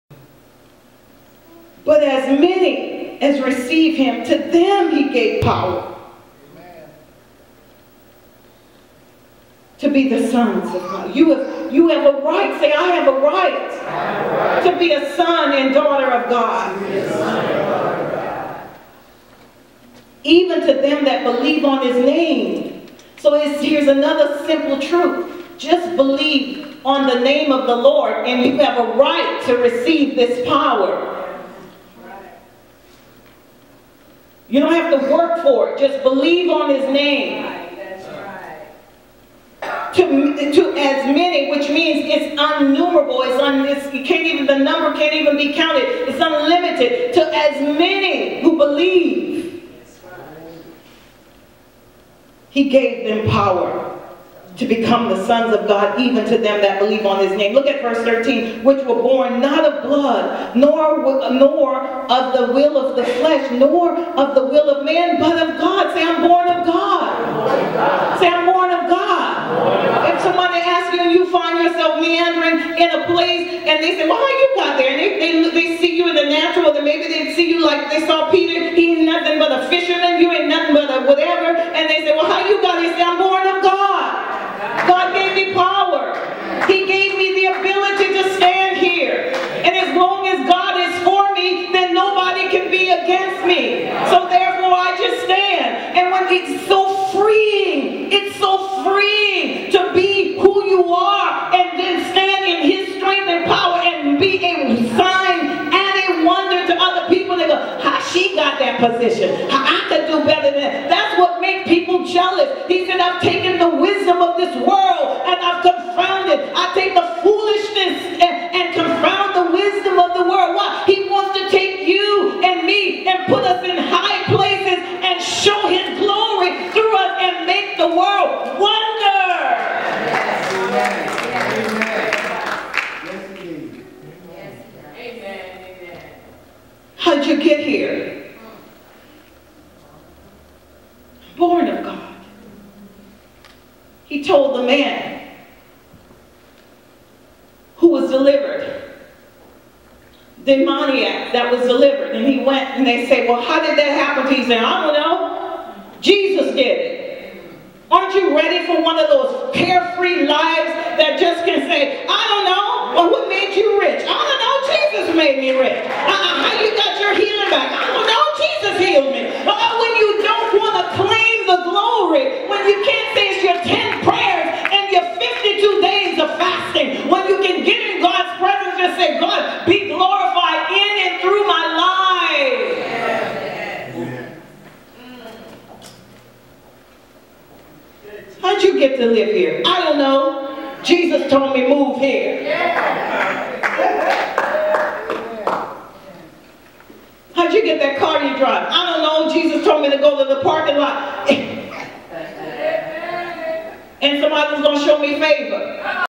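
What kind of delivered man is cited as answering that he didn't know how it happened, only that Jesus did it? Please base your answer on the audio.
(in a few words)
demoniac.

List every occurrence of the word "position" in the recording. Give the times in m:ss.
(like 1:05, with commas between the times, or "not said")
1:48.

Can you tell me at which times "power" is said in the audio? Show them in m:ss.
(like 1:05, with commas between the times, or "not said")
0:05, 0:30, 0:53.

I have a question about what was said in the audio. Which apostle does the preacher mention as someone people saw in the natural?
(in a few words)
Peter.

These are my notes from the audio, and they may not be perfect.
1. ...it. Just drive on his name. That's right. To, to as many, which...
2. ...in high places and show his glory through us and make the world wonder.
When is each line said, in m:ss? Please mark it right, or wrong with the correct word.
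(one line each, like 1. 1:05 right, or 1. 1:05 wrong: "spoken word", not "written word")
1. 0:35 wrong: "believe", not "drive"
2. 2:03 right.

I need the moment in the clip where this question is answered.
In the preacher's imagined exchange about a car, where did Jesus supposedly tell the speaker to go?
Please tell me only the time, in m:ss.
3:20.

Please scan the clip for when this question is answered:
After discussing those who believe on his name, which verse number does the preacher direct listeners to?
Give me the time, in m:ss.
0:57.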